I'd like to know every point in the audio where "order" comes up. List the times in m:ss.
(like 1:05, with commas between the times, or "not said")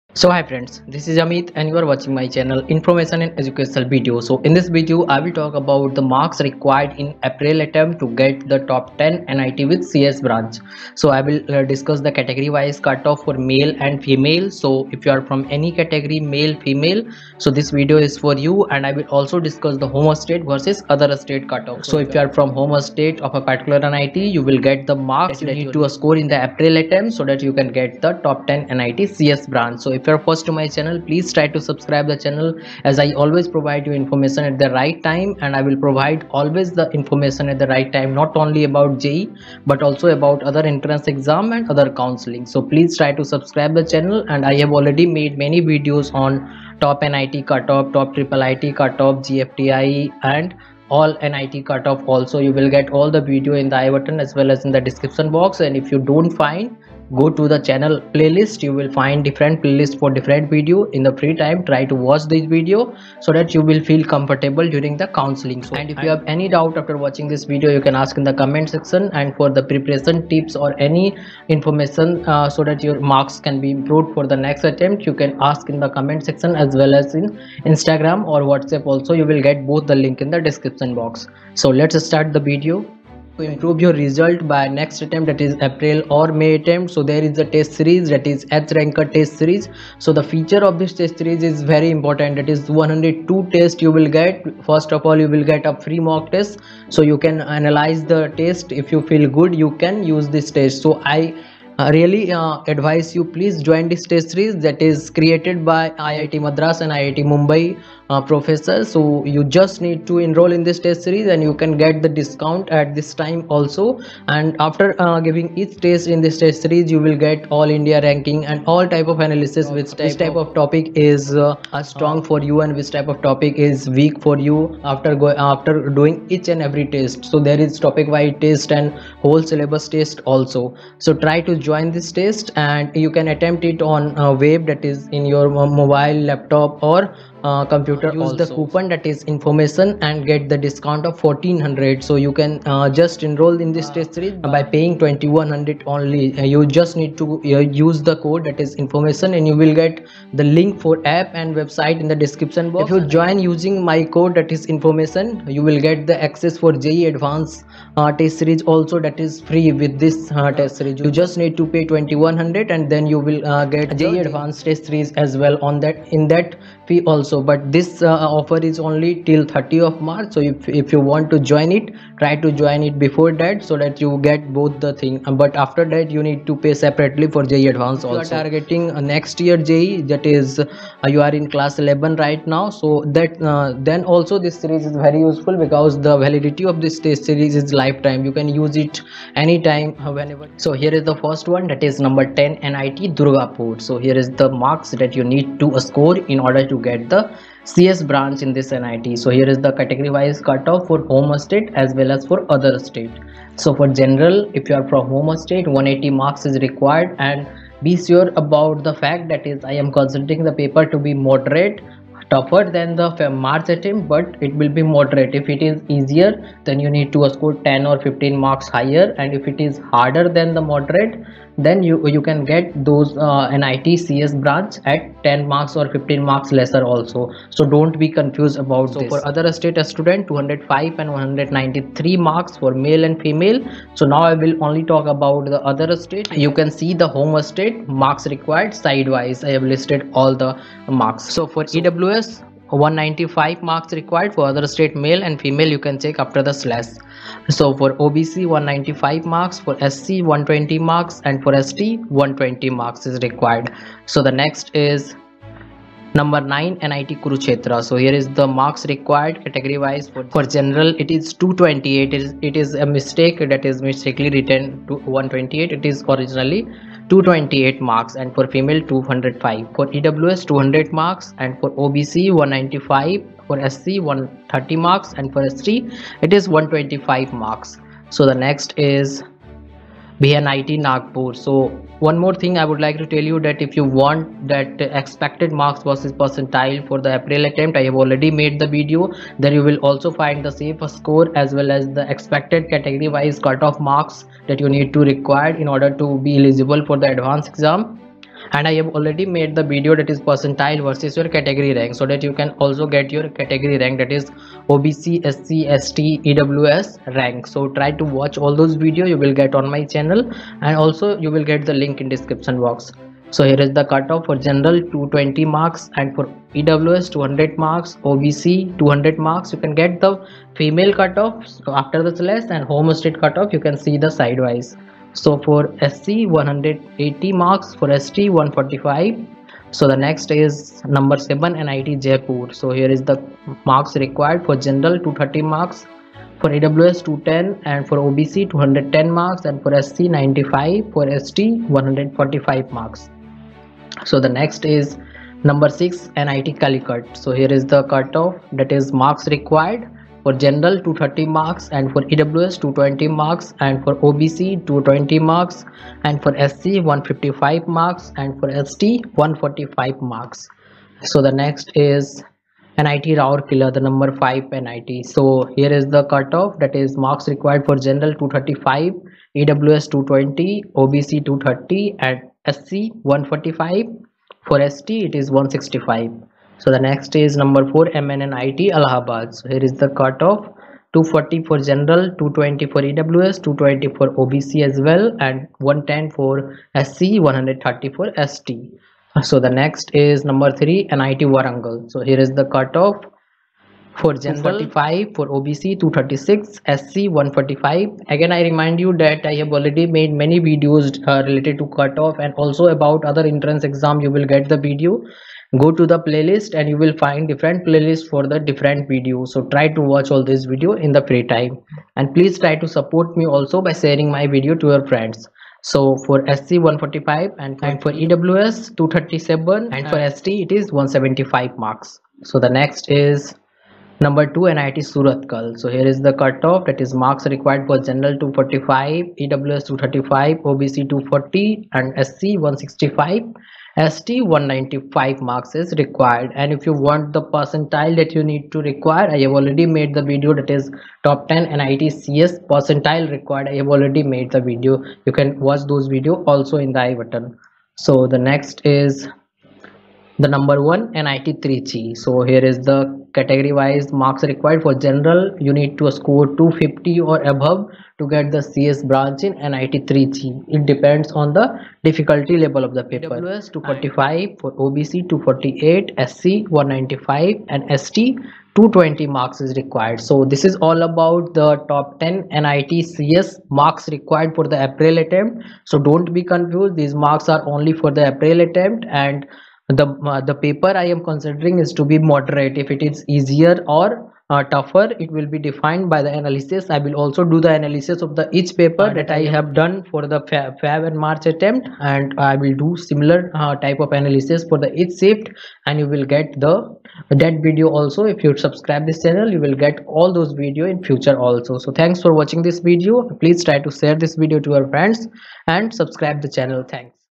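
3:16, 4:55.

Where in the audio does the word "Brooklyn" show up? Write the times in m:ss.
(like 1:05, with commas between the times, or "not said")
not said.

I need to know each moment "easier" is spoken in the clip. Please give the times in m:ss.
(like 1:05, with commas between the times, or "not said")
3:35, 8:03.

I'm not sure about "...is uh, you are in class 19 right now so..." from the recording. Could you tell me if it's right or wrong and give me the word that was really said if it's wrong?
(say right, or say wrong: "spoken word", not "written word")
wrong: "11", not "19".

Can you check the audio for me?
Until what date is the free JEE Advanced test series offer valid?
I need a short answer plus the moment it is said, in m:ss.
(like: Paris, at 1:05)
30 March, at 2:49.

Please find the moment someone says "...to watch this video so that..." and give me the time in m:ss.
1:01.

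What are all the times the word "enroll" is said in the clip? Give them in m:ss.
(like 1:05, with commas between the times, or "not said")
1:50, 2:23.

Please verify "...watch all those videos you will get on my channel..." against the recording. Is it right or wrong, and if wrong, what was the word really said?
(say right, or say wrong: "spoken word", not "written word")
right.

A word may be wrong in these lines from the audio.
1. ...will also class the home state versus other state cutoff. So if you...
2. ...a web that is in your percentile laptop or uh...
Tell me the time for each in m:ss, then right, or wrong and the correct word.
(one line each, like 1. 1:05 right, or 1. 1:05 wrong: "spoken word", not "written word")
1. 0:18 wrong: "discuss", not "class"
2. 2:14 wrong: "mobile", not "percentile".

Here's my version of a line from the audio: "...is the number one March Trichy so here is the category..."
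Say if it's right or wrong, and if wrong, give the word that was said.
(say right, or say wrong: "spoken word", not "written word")
wrong: "NIT", not "March".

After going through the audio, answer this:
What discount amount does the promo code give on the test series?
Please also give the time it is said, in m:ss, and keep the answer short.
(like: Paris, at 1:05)
1400, at 2:21.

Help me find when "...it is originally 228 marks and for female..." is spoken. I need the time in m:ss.
4:25.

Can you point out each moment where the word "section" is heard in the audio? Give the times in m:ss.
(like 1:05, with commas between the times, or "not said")
1:08, 1:16.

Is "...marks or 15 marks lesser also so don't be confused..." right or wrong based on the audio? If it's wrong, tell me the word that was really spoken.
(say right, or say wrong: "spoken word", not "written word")
right.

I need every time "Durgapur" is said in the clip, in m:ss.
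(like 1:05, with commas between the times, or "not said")
3:13.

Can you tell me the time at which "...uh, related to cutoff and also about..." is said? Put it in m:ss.
6:41.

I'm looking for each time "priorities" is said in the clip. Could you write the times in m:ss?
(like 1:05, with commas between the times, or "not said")
not said.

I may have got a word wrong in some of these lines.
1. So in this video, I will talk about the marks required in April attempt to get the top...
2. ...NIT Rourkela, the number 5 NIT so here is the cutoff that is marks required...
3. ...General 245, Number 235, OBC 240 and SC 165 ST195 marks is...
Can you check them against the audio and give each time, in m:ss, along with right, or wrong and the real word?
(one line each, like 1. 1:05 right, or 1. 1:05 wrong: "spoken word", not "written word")
1. 0:04 right
2. 6:02 right
3. 7:07 wrong: "EWS", not "Number".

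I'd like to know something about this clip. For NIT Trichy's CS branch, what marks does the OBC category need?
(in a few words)
248.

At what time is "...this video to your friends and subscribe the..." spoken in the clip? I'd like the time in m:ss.
8:23.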